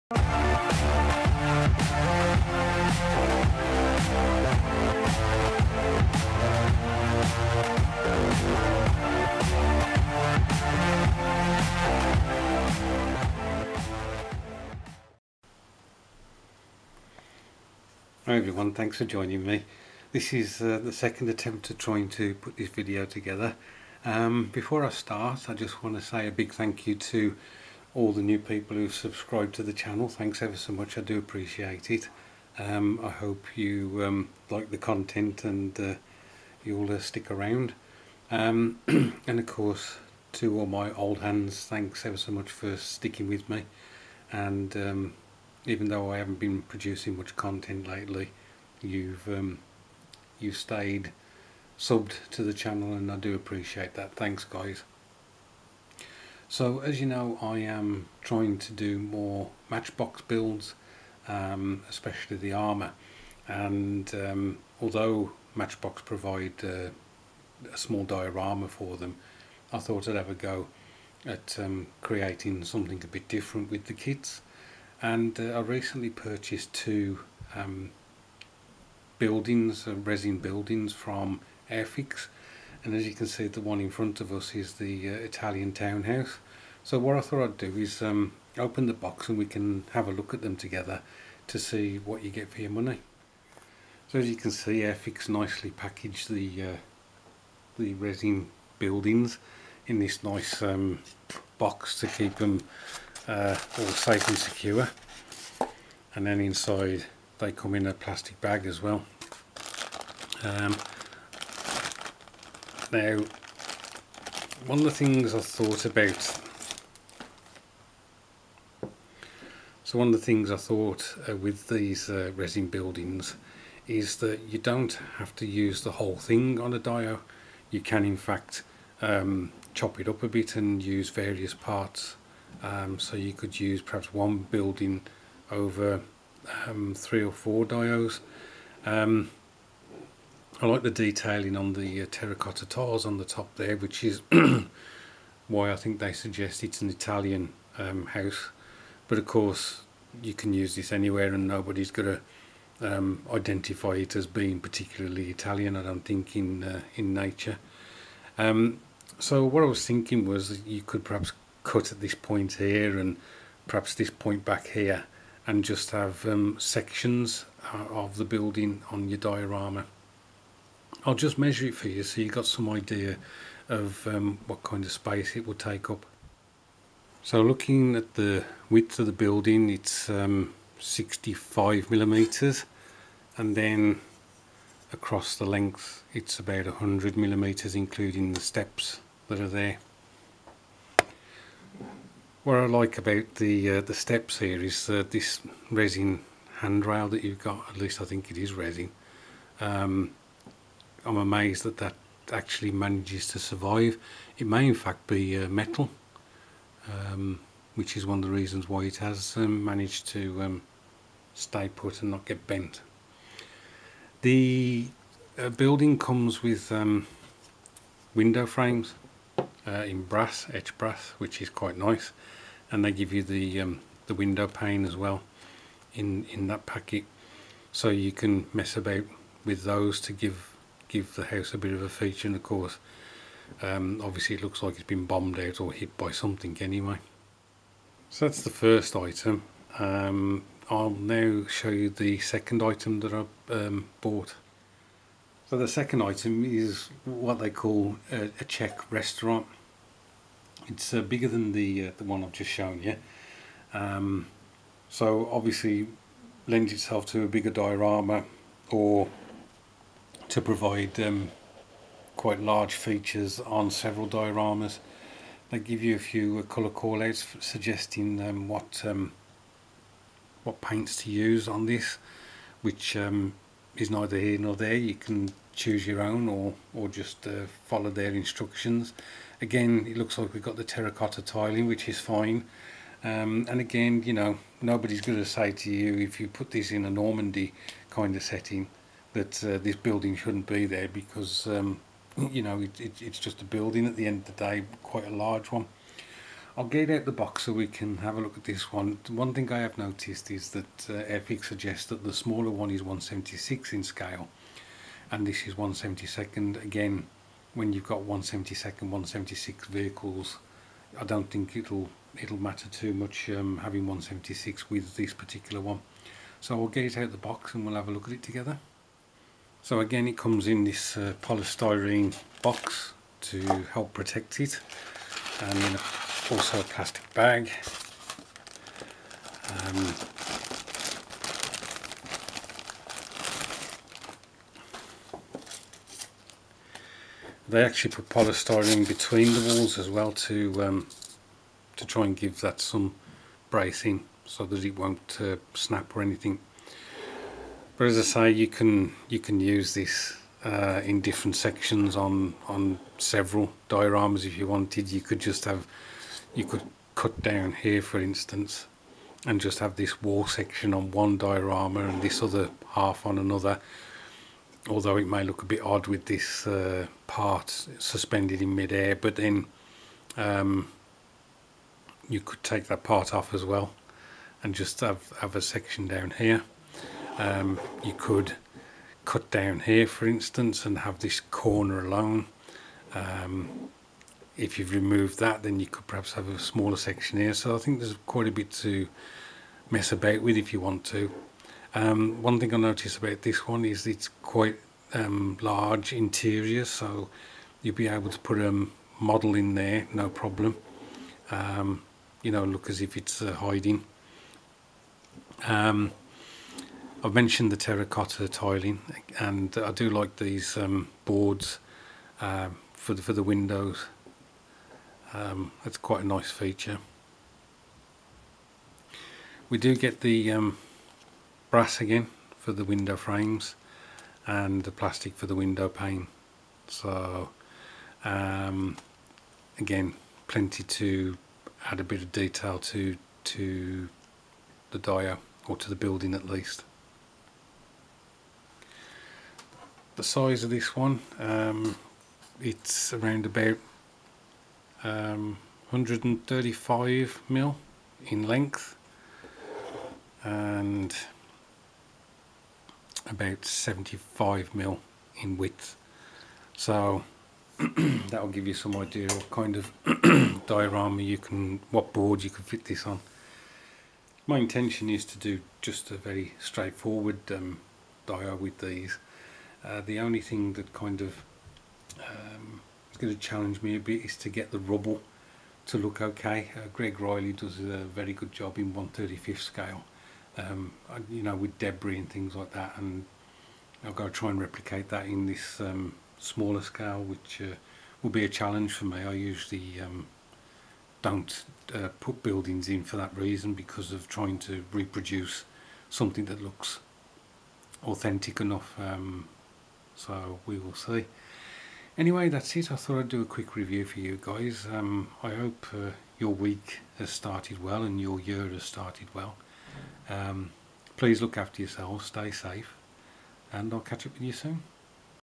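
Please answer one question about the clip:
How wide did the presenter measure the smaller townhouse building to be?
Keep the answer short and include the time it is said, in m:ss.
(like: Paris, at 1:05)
65 millimeters, at 3:00.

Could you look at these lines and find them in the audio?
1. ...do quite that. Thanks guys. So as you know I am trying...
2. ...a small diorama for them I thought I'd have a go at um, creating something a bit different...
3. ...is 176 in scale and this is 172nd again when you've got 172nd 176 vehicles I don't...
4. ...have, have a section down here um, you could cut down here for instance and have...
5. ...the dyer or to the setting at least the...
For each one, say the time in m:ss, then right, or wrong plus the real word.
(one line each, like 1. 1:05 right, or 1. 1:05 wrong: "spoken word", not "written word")
1. 0:53 wrong: "appreciate", not "quite"
2. 1:07 right
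3. 5:02 right
4. 6:14 right
5. 7:14 wrong: "building", not "setting".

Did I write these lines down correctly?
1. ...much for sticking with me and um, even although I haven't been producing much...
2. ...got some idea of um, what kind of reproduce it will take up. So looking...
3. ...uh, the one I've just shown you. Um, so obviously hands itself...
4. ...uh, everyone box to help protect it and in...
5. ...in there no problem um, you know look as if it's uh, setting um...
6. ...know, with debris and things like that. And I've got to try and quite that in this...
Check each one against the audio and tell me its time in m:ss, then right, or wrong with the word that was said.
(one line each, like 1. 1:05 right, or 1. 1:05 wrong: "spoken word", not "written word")
1. 0:42 wrong: "though", not "although"
2. 2:52 wrong: "space", not "reproduce"
3. 4:11 wrong: "lends", not "hands"
4. 5:20 wrong: "polystyrene", not "everyone"
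5. 6:39 wrong: "hiding", not "setting"
6. 8:01 wrong: "replicate", not "quite".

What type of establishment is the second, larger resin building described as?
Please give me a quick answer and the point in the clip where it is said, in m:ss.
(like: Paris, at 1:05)
A Czech restaurant, at 4:08.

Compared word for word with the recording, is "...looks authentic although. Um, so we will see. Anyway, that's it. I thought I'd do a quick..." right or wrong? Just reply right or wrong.
wrong.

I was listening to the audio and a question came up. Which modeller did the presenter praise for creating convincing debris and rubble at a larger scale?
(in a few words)
Greg Riley.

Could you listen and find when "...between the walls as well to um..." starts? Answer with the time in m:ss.
5:38.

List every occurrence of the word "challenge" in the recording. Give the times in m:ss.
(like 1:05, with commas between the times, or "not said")
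7:53, 8:08.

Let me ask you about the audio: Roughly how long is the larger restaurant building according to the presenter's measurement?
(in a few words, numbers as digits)
135 mm.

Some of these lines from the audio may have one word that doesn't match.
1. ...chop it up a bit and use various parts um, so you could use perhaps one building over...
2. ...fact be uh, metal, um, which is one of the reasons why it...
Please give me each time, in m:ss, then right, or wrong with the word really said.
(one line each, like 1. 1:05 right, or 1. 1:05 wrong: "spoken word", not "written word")
1. 2:09 right
2. 3:24 right.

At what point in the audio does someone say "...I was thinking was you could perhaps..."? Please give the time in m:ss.
2:39.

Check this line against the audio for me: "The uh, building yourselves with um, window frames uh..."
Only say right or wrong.
wrong.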